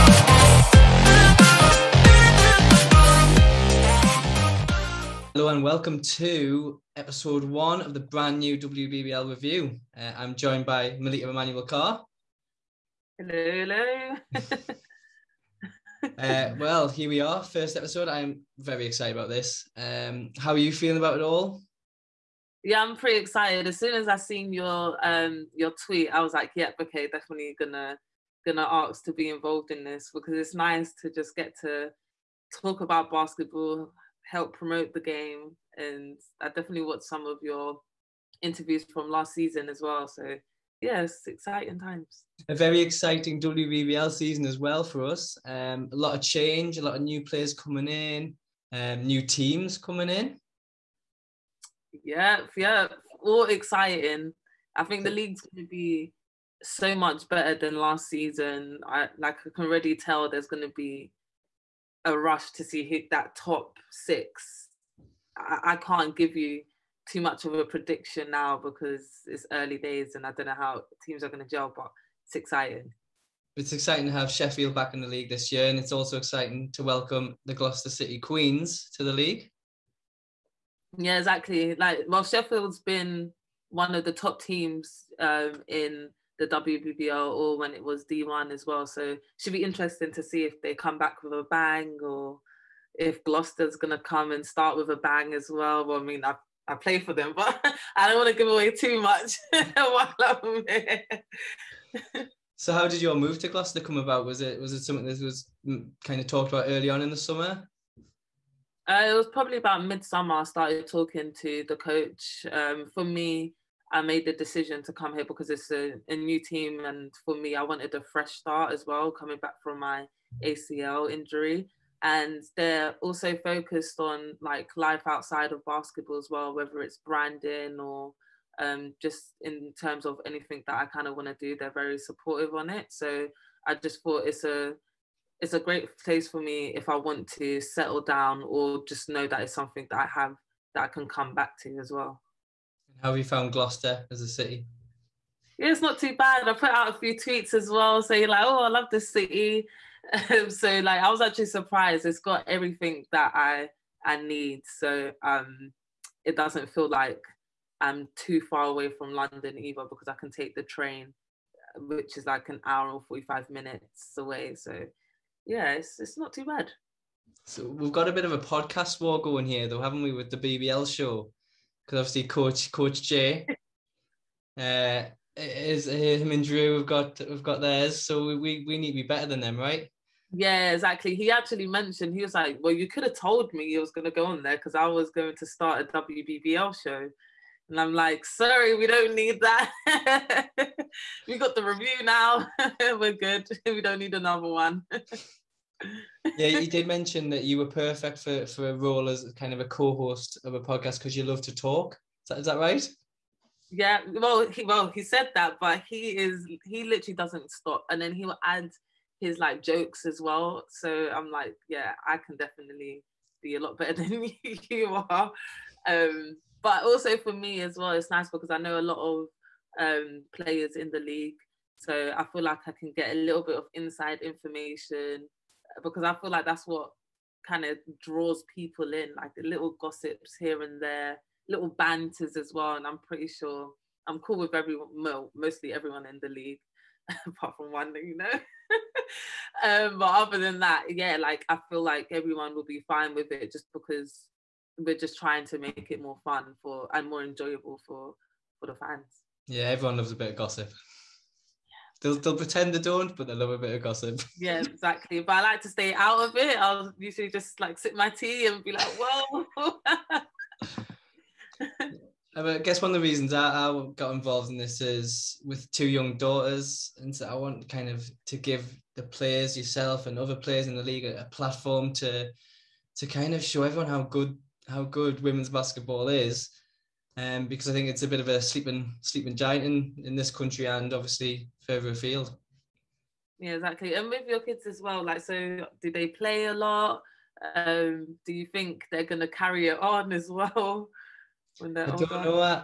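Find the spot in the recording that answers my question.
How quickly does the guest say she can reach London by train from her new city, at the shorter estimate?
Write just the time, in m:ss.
2:43.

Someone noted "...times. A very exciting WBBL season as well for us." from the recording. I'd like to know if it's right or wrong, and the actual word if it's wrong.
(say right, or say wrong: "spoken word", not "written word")
right.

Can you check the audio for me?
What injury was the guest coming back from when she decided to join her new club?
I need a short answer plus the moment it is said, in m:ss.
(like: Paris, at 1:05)
ACL injury, at 2:00.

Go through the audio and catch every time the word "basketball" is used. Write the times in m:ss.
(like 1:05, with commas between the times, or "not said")
0:33, 2:05, 4:35.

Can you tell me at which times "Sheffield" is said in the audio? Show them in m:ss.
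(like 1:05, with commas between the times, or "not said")
1:14, 1:22.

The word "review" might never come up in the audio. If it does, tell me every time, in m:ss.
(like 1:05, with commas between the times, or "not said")
0:09, 3:11.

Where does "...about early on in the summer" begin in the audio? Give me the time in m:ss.
1:46.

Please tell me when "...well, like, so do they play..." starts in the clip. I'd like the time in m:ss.
4:44.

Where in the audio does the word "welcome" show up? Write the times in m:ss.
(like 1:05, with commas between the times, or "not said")
0:05, 1:16.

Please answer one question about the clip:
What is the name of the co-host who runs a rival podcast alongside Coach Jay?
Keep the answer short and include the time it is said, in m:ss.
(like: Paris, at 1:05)
Drew, at 2:56.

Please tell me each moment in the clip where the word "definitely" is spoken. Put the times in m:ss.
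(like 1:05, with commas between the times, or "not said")
0:27, 0:36, 3:32.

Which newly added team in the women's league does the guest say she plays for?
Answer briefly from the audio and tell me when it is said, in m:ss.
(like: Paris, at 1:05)
Gloucester City Queens, at 1:17.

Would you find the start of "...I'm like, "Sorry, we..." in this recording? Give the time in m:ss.
3:07.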